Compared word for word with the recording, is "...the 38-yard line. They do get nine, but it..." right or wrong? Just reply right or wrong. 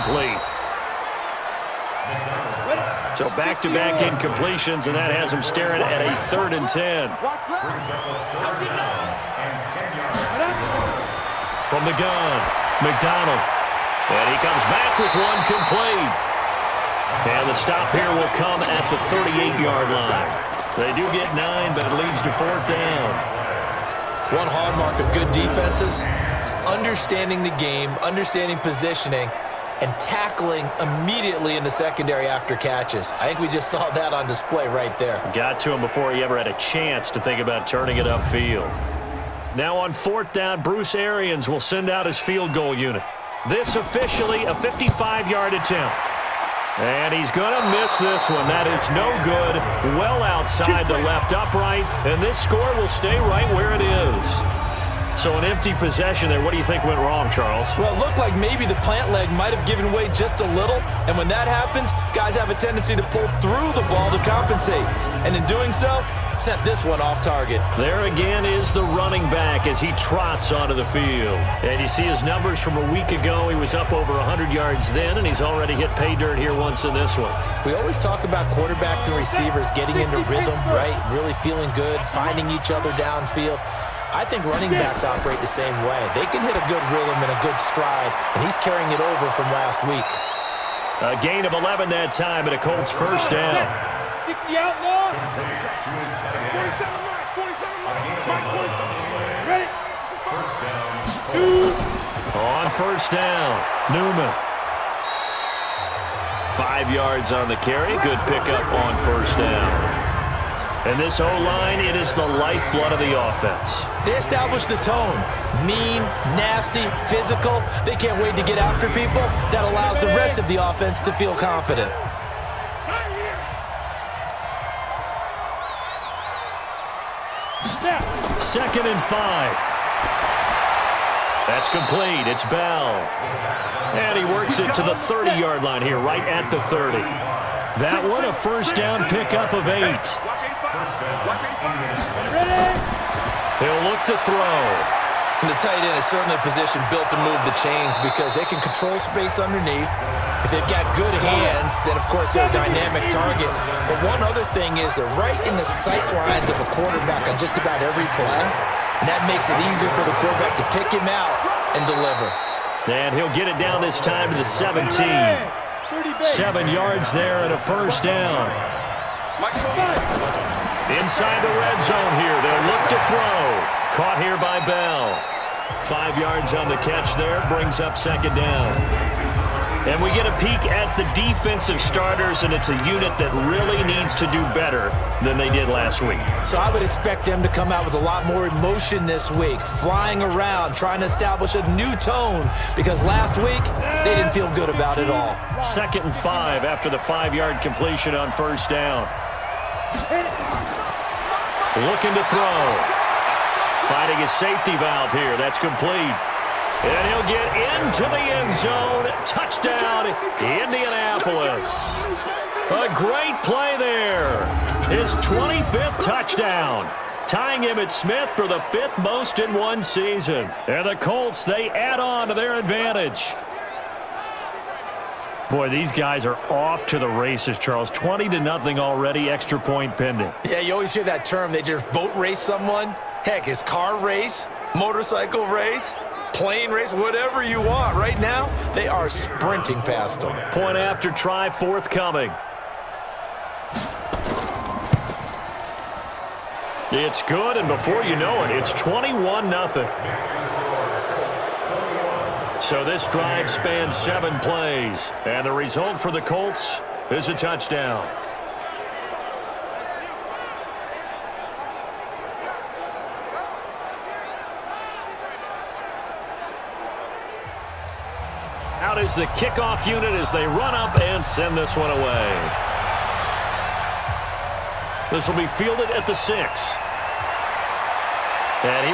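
right.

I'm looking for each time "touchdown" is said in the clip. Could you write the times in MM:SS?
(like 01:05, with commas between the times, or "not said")
03:29, 03:36, 04:17.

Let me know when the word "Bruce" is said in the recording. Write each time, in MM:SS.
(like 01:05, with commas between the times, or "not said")
00:40.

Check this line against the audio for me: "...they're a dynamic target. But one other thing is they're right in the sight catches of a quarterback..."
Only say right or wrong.
wrong.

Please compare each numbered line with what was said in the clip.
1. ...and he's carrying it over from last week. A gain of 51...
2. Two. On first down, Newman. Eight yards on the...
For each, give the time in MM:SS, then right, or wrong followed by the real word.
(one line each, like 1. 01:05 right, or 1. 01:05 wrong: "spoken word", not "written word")
1. 01:28 wrong: "11", not "51"
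2. 01:41 wrong: "Five", not "Eight".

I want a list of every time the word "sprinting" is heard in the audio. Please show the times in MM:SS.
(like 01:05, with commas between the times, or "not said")
03:59.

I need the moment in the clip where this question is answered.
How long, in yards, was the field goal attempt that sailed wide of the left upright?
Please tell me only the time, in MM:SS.
00:44.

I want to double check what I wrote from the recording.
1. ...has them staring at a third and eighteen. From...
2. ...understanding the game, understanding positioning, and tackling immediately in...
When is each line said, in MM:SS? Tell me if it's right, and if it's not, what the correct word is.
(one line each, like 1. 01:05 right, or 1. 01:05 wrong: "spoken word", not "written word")
1. 00:05 wrong: "ten", not "eighteen"
2. 00:26 right.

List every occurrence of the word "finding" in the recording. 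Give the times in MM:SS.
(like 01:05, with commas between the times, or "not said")
01:22, 03:23.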